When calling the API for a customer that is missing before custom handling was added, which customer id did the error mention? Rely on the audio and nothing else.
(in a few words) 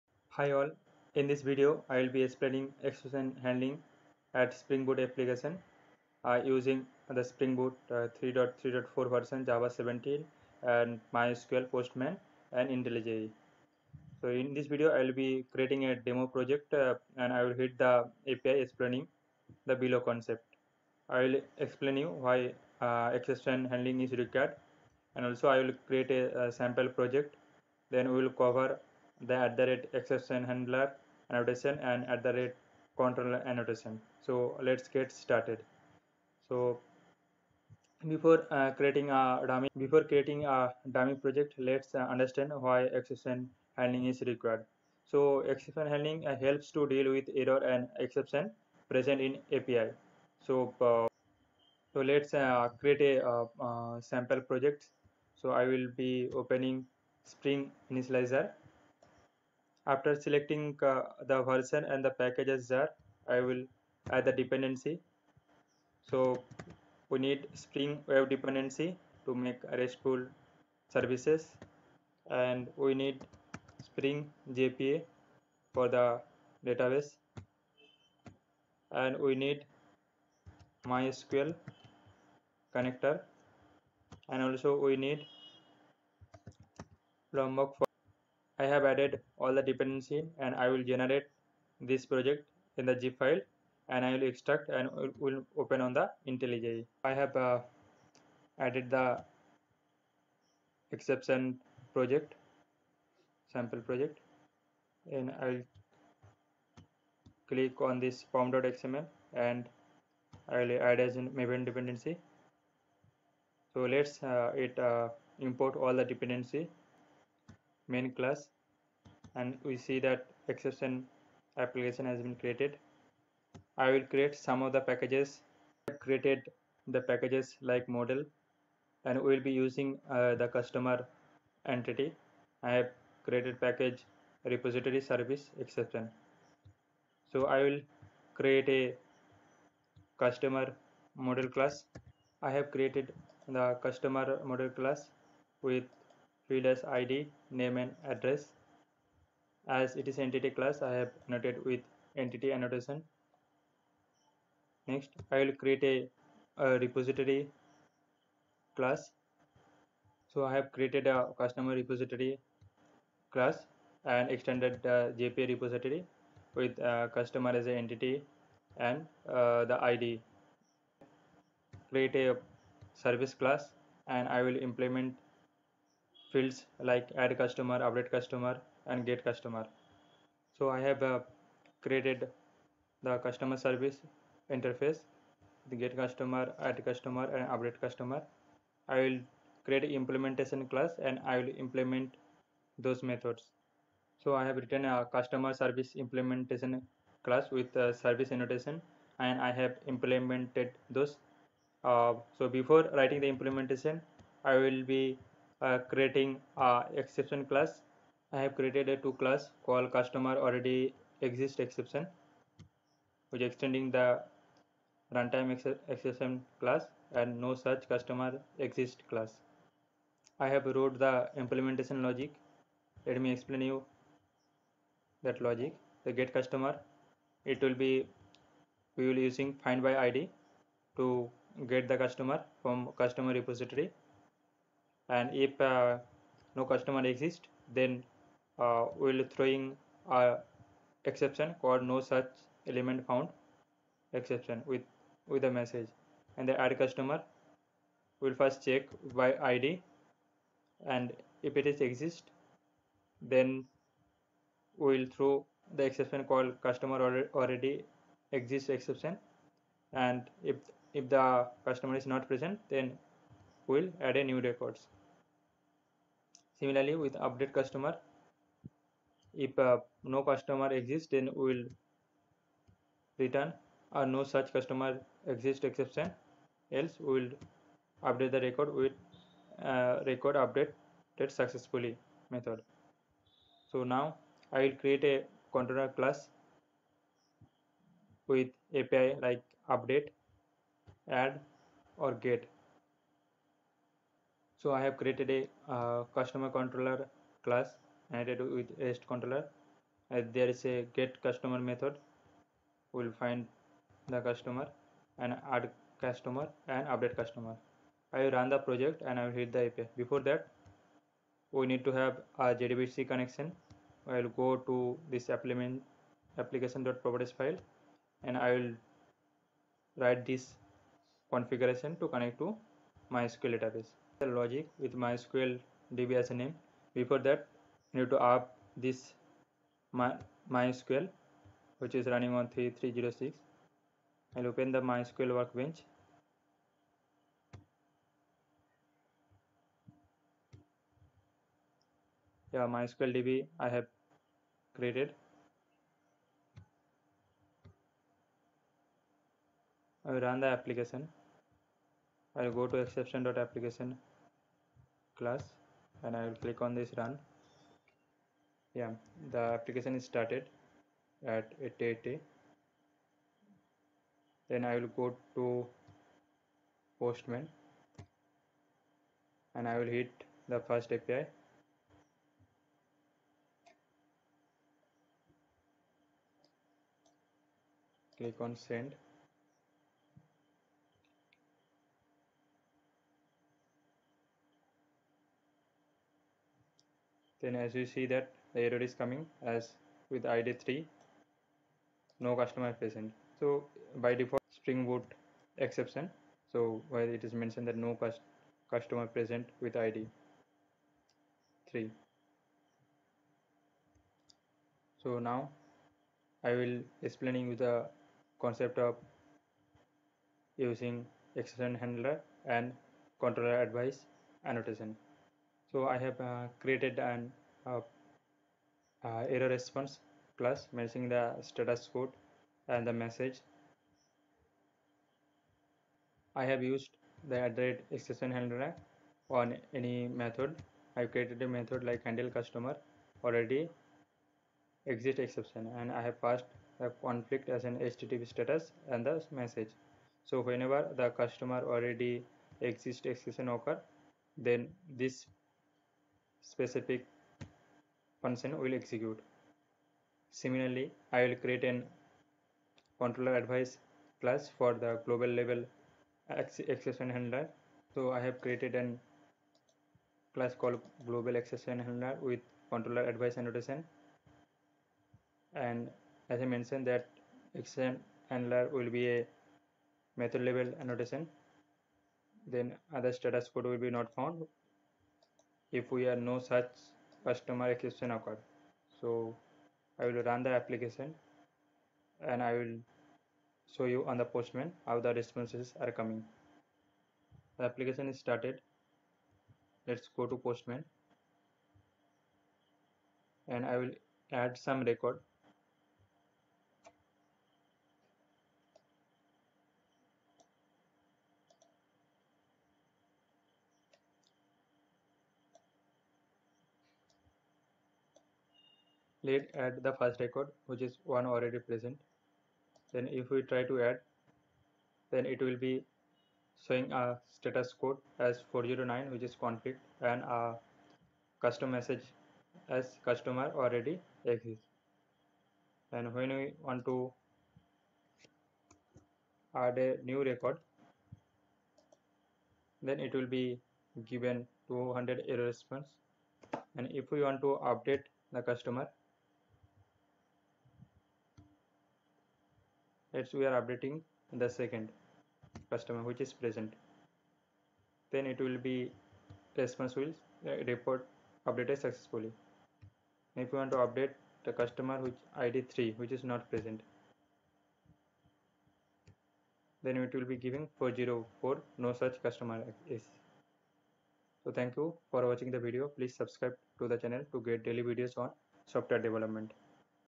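3.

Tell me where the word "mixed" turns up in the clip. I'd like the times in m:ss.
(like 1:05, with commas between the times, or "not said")
not said.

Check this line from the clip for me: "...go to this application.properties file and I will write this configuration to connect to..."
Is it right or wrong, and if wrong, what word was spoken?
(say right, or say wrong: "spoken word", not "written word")
right.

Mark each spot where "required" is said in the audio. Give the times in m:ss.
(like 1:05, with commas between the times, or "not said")
0:24, 0:44.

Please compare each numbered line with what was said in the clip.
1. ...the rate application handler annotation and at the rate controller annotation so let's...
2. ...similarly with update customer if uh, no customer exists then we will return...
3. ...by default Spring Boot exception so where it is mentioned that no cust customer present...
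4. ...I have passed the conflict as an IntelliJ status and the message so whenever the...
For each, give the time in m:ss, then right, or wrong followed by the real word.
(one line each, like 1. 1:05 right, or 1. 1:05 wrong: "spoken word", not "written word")
1. 0:29 wrong: "exception", not "application"
2. 4:26 right
3. 6:34 right
4. 7:15 wrong: "HTTP", not "IntelliJ".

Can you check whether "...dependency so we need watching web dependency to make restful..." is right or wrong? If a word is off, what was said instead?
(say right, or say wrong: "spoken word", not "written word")
wrong: "spring", not "watching".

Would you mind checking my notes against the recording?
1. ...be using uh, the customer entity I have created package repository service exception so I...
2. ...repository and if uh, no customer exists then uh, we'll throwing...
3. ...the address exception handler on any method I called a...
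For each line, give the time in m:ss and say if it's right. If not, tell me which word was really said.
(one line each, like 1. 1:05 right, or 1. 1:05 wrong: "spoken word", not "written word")
1. 2:09 right
2. 3:53 right
3. 7:07 wrong: "created", not "called".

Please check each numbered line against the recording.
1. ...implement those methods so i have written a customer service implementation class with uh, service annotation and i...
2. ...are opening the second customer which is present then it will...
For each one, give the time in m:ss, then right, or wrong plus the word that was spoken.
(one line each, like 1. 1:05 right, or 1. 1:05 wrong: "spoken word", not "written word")
1. 3:11 right
2. 9:03 wrong: "updating", not "opening".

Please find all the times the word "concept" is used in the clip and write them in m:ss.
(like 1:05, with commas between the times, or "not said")
0:19, 6:48.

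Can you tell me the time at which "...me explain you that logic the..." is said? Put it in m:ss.
3:43.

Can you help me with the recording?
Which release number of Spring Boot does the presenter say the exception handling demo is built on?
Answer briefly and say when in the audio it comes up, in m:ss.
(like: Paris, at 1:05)
3.3.4, at 0:07.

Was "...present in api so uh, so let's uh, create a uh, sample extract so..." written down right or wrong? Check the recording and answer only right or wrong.
wrong.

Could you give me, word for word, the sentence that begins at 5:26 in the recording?
Before that, you need to up this my, MySQL which is running on 3306.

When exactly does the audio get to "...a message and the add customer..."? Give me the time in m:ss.
4:05.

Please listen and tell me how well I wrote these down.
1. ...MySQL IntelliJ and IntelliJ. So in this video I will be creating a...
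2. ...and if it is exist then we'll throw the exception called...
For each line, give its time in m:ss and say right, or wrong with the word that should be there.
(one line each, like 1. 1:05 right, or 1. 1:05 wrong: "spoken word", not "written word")
1. 0:11 wrong: "Postman", not "IntelliJ"
2. 4:10 right.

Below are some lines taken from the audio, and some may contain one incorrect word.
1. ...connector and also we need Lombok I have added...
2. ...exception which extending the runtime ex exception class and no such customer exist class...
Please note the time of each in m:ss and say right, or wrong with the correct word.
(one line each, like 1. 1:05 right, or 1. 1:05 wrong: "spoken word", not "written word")
1. 1:22 right
2. 3:31 right.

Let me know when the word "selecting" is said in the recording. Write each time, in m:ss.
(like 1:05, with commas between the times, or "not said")
1:00.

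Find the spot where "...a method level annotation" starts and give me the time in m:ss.
7:49.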